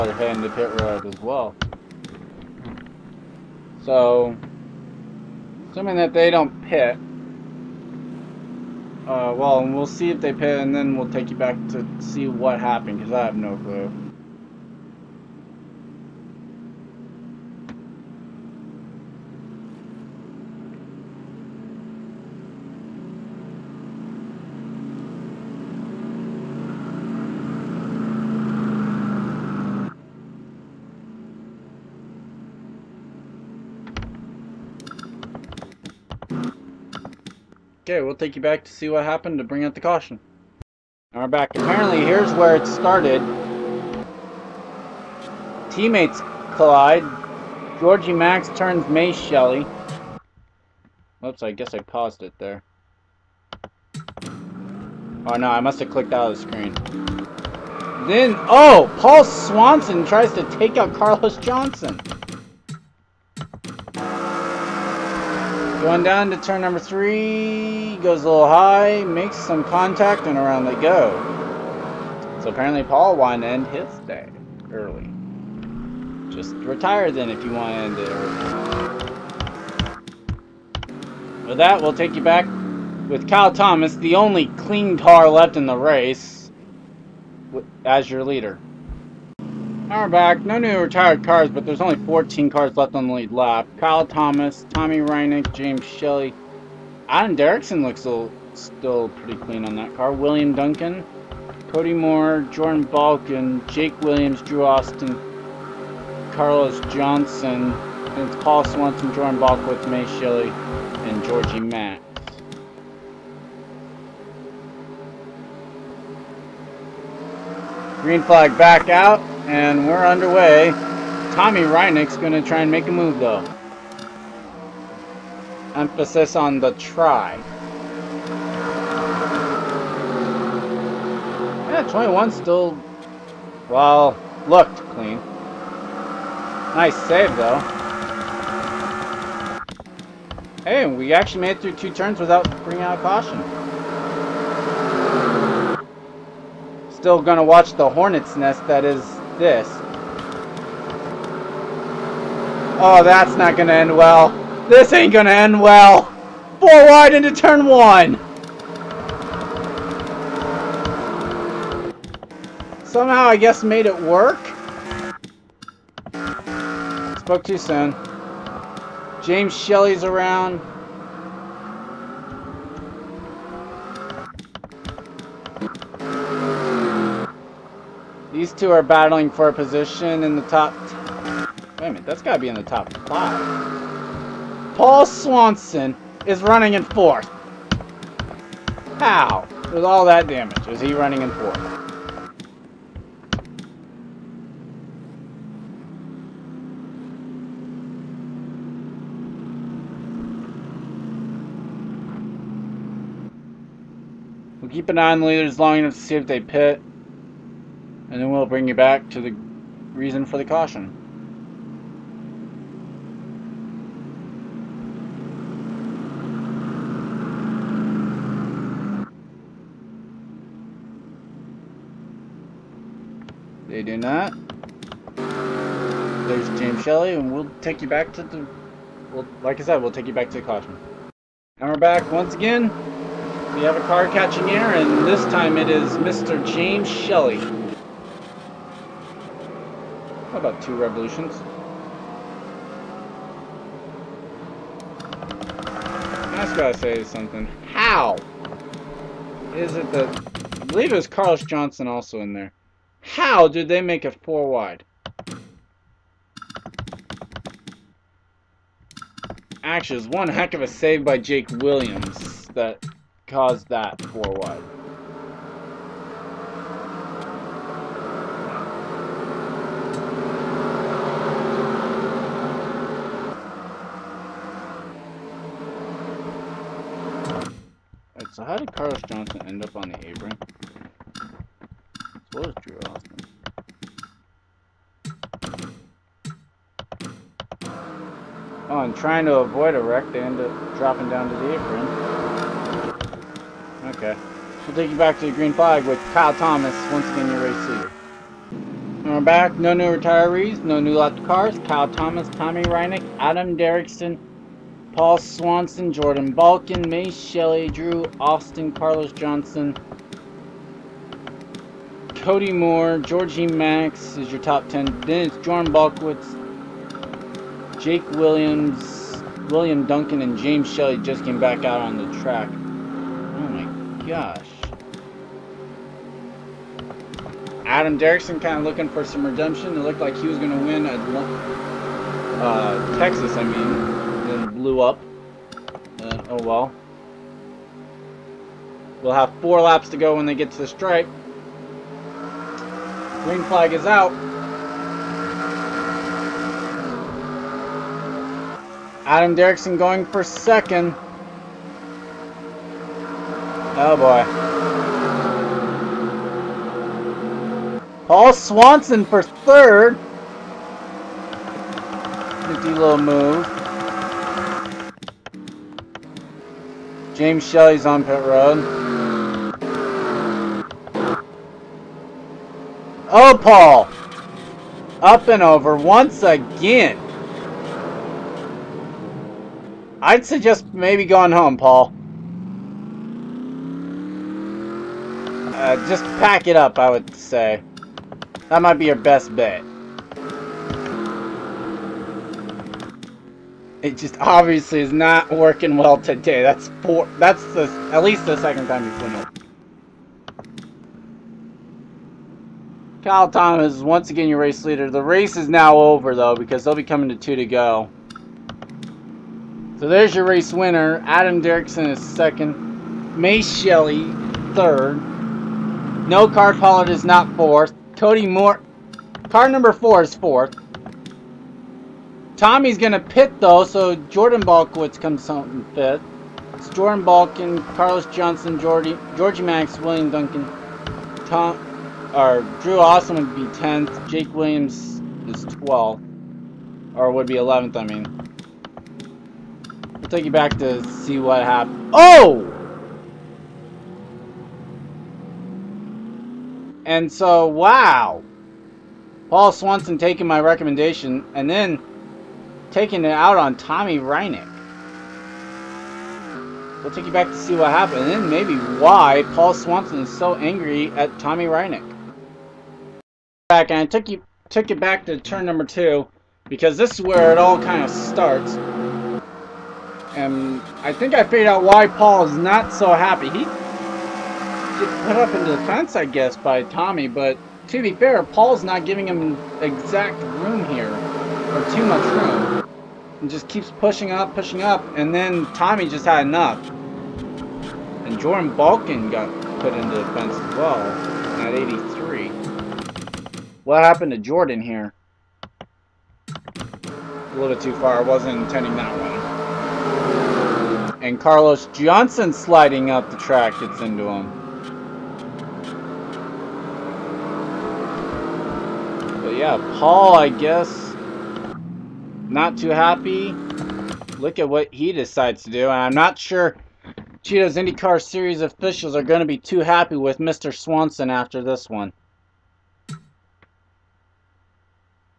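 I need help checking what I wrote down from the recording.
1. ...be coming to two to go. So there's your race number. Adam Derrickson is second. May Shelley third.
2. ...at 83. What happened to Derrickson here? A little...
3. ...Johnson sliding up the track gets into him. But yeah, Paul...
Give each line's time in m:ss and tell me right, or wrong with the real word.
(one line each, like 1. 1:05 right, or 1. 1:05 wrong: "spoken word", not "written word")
1. 6:46 wrong: "winner", not "number"
2. 8:11 wrong: "Jordan", not "Derrickson"
3. 8:21 right.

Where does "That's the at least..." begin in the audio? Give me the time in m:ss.
6:37.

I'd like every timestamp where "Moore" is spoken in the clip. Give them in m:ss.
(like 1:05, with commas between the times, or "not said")
1:41, 5:12, 6:58.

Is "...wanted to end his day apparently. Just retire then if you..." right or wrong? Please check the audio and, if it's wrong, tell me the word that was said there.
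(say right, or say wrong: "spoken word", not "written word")
wrong: "early", not "apparently".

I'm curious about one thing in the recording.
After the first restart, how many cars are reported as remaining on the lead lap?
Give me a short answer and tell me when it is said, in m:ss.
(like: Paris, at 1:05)
14, at 1:32.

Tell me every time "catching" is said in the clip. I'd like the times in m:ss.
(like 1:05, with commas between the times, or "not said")
3:54.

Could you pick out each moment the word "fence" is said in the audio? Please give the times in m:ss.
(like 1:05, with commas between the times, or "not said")
7:55, 8:10.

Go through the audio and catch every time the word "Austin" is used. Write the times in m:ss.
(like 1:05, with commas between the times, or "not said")
1:44, 4:47, 5:08, 7:12.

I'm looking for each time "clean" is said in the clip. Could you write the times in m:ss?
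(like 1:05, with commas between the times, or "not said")
1:24, 1:39, 2:14.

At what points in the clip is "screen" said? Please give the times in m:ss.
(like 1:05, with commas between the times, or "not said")
0:56.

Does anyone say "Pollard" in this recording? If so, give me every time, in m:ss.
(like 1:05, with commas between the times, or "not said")
6:56.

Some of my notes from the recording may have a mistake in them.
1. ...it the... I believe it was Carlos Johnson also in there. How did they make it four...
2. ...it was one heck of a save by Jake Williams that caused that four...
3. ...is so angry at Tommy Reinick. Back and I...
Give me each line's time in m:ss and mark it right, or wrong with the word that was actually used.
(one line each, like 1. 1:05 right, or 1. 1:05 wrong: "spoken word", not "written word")
1. 4:09 right
2. 4:19 right
3. 7:40 right.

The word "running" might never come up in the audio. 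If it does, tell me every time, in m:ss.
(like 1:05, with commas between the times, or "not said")
3:06, 3:10.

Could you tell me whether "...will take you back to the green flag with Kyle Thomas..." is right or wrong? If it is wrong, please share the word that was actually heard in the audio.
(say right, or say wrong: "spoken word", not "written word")
right.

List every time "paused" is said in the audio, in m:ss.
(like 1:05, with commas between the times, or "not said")
0:51.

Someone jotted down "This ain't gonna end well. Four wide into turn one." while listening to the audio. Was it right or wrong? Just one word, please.
right.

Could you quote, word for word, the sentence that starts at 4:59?
No new retirees, no new left cars.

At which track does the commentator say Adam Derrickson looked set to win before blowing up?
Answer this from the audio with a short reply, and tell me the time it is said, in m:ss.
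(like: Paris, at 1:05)
Texas, at 5:32.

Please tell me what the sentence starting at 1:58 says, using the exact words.
Green flag back out and we're underway.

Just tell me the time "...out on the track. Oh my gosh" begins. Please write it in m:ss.
5:21.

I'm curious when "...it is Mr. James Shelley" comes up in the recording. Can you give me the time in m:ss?
3:55.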